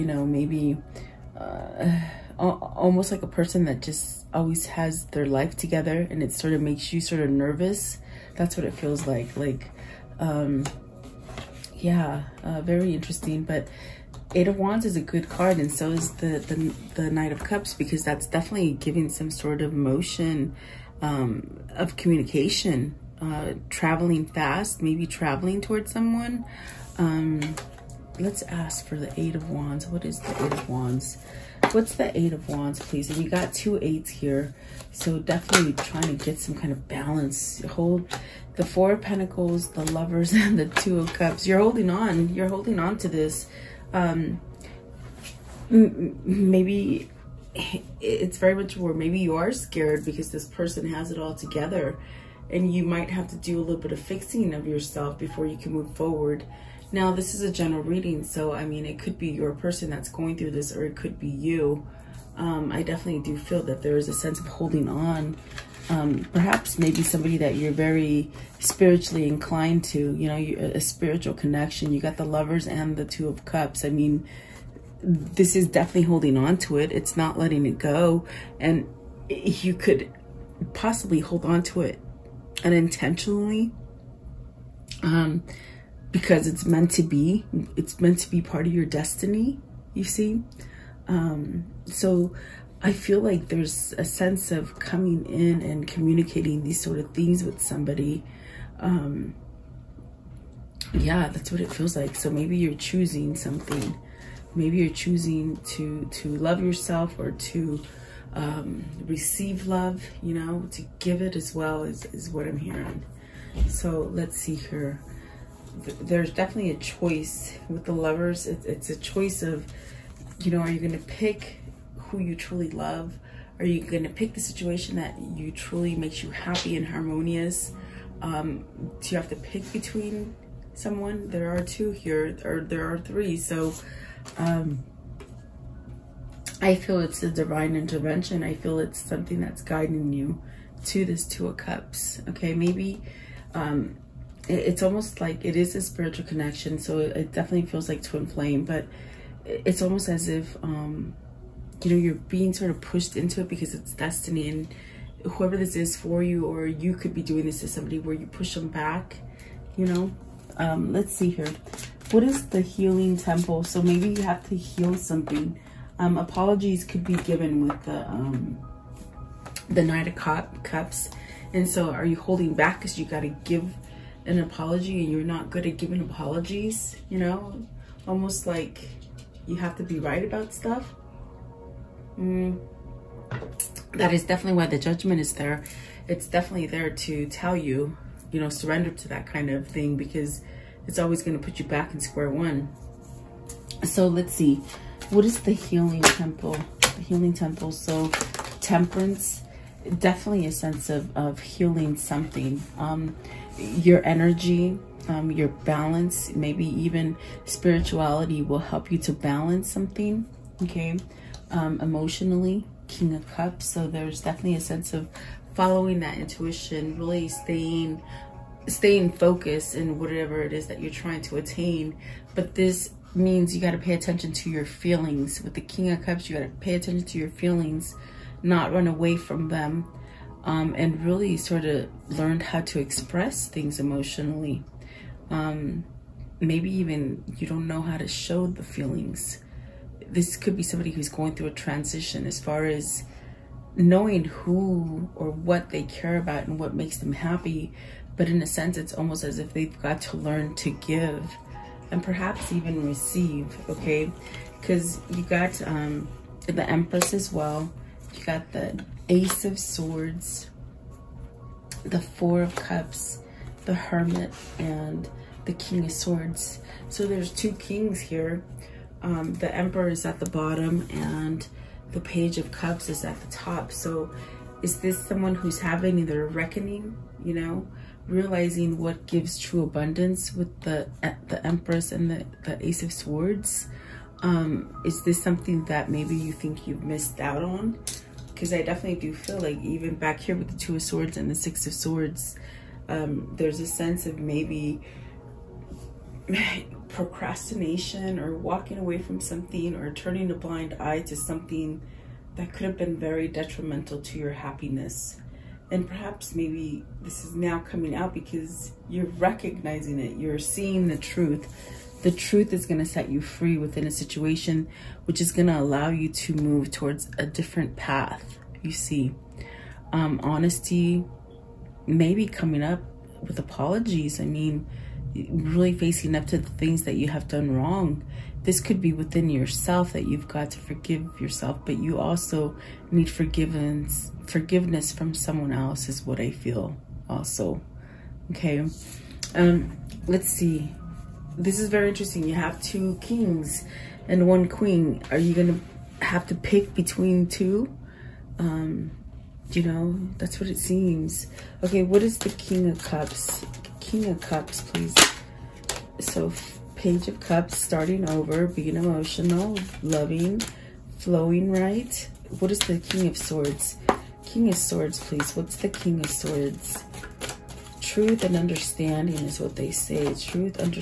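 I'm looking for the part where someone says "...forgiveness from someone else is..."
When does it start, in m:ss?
5:34.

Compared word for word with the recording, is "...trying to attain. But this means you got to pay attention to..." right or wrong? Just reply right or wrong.
right.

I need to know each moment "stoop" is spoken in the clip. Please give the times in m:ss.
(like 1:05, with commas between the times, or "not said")
not said.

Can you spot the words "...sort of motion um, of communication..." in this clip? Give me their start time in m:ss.
0:19.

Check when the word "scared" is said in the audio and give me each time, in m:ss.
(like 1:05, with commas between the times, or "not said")
0:49.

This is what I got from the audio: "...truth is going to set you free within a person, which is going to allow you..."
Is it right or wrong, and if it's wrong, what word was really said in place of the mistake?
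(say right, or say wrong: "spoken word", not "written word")
wrong: "situation", not "person".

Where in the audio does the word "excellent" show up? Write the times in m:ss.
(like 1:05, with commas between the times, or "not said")
not said.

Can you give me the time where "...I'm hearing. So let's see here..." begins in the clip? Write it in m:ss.
1:52.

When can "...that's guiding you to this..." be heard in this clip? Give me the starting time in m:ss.
2:19.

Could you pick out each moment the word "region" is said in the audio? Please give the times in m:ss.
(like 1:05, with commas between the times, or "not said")
not said.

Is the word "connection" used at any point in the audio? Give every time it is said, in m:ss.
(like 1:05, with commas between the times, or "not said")
1:11, 2:26.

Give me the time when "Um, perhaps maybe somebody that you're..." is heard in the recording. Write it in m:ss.
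1:05.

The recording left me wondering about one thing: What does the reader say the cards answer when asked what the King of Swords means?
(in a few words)
Truth and understanding.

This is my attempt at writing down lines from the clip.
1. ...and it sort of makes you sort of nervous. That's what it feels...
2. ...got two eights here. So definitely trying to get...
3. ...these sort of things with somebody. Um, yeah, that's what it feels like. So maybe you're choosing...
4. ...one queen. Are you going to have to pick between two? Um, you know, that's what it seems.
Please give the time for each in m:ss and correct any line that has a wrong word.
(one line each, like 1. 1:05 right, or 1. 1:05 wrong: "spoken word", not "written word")
1. 0:06 right
2. 0:33 right
3. 1:36 right
4. 5:44 right.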